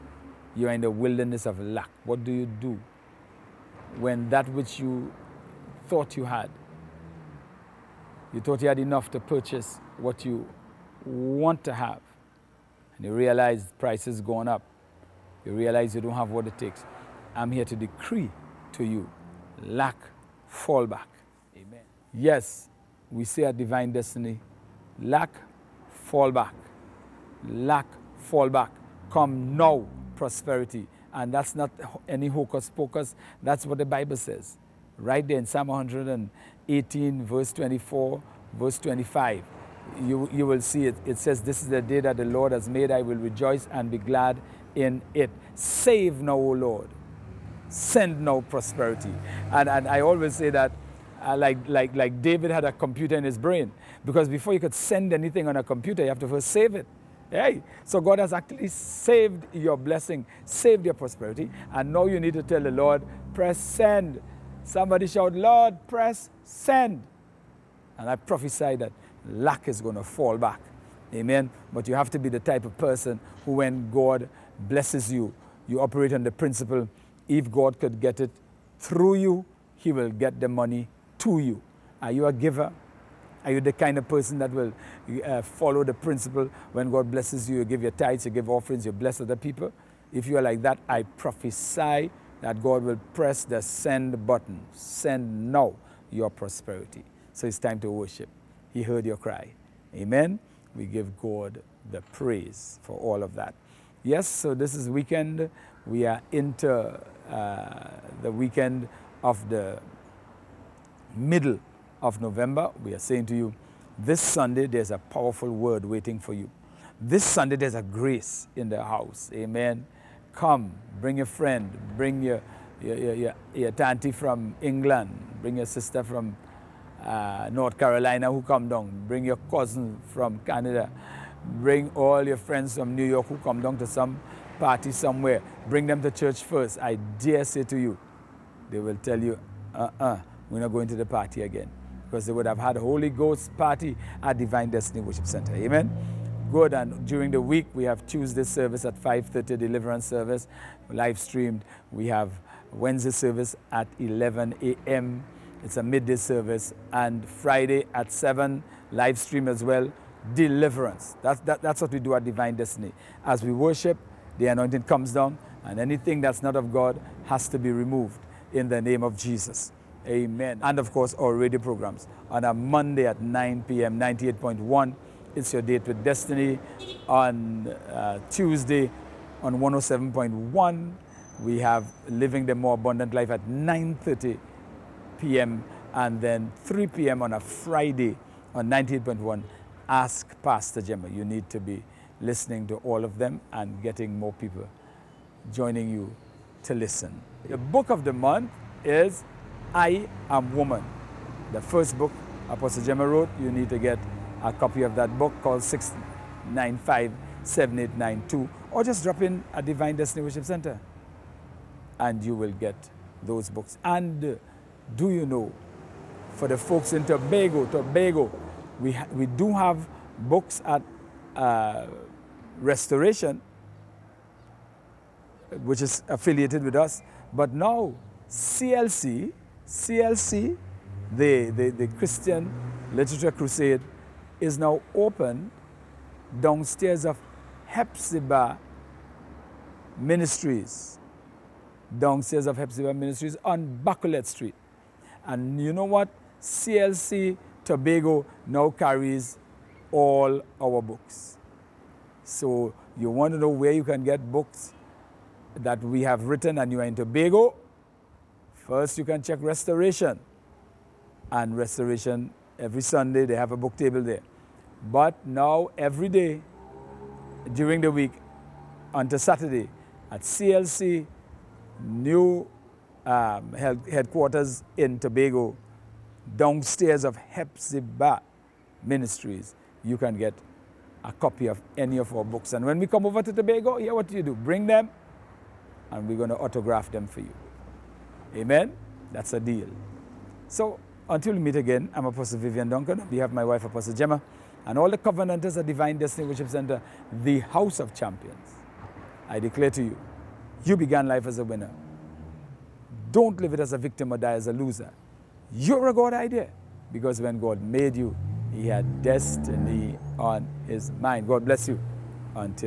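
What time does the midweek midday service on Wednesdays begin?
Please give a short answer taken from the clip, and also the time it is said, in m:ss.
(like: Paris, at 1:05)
11 a.m., at 2:33.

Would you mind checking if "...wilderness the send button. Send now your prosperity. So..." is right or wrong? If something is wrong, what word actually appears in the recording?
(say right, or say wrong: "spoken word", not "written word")
wrong: "press", not "wilderness".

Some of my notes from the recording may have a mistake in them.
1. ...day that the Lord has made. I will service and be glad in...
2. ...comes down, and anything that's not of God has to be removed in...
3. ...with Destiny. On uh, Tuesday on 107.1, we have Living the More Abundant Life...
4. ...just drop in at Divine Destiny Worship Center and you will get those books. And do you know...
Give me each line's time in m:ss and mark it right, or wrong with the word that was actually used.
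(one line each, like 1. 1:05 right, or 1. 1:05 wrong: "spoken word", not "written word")
1. 0:41 wrong: "rejoice", not "service"
2. 2:44 right
3. 2:55 right
4. 3:28 right.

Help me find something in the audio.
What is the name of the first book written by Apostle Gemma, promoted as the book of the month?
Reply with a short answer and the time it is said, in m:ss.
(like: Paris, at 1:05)
I Am Woman, at 3:19.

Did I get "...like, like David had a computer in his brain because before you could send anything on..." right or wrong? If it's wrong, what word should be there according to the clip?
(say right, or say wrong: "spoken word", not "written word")
right.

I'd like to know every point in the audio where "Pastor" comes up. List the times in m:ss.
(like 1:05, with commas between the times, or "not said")
3:10.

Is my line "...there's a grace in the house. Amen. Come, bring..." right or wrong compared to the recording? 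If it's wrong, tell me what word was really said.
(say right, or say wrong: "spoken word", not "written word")
right.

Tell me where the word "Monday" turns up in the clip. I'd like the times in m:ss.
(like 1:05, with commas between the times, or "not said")
2:52.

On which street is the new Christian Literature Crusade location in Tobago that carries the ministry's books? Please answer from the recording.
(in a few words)
Bacolet Street.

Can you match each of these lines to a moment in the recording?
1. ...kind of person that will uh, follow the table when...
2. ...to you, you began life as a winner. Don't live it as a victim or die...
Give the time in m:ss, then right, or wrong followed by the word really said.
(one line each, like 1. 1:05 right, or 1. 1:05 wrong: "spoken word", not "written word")
1. 1:23 wrong: "principle", not "table"
2. 4:59 right.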